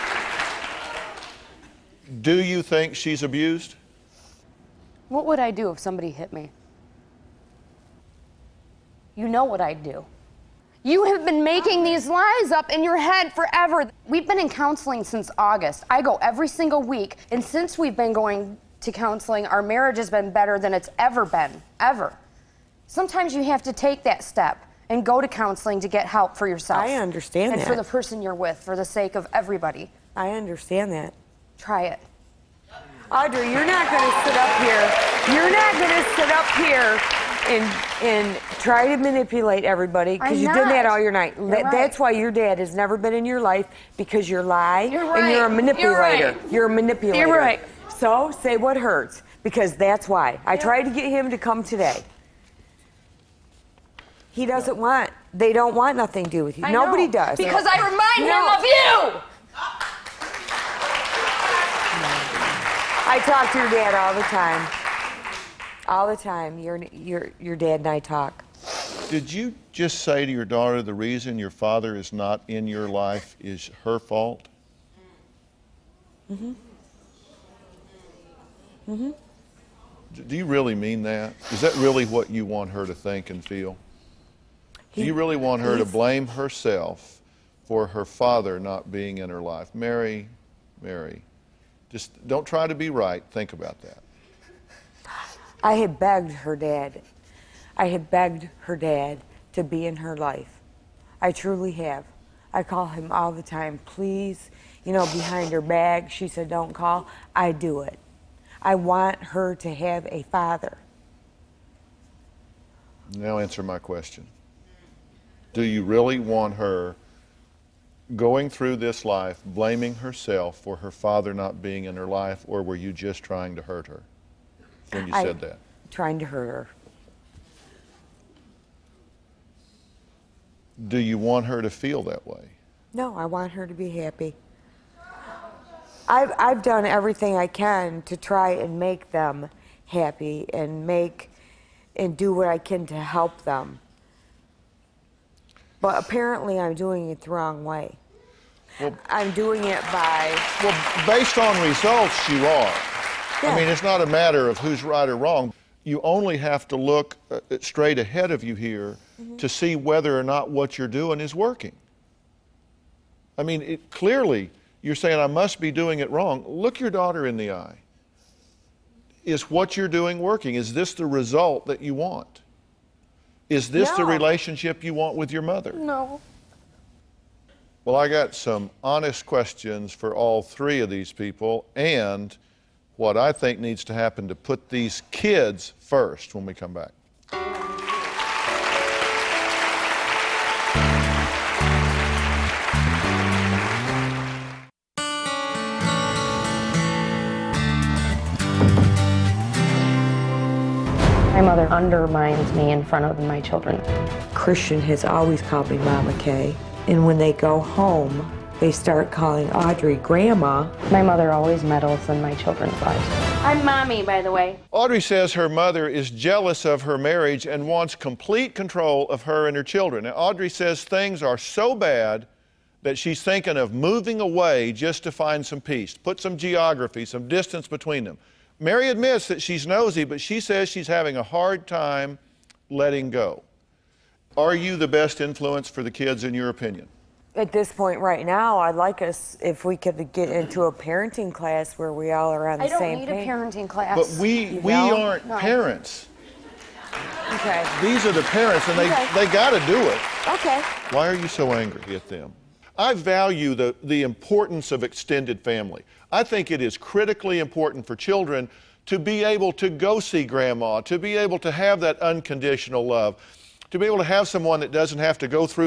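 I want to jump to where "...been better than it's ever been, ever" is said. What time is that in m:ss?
0:20.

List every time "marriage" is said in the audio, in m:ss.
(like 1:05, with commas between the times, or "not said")
0:19, 3:36.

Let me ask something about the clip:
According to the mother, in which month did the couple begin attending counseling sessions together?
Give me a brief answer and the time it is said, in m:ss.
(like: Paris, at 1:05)
August, at 0:15.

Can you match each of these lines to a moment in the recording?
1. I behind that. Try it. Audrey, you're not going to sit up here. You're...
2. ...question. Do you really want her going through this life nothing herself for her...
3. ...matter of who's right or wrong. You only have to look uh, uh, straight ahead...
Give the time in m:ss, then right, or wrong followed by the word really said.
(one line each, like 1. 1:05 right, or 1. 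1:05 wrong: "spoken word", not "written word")
1. 0:30 wrong: "understand", not "behind"
2. 1:53 wrong: "blaming", not "nothing"
3. 2:34 right.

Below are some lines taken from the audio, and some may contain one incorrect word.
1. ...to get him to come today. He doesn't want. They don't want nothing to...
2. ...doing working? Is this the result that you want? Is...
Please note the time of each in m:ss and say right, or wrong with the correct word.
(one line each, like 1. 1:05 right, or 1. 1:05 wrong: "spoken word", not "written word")
1. 0:50 right
2. 2:49 right.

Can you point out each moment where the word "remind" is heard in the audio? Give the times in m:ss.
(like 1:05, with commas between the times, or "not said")
0:57.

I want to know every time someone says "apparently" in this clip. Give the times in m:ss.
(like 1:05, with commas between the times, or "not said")
2:26.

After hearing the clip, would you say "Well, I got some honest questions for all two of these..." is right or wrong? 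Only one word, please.
wrong.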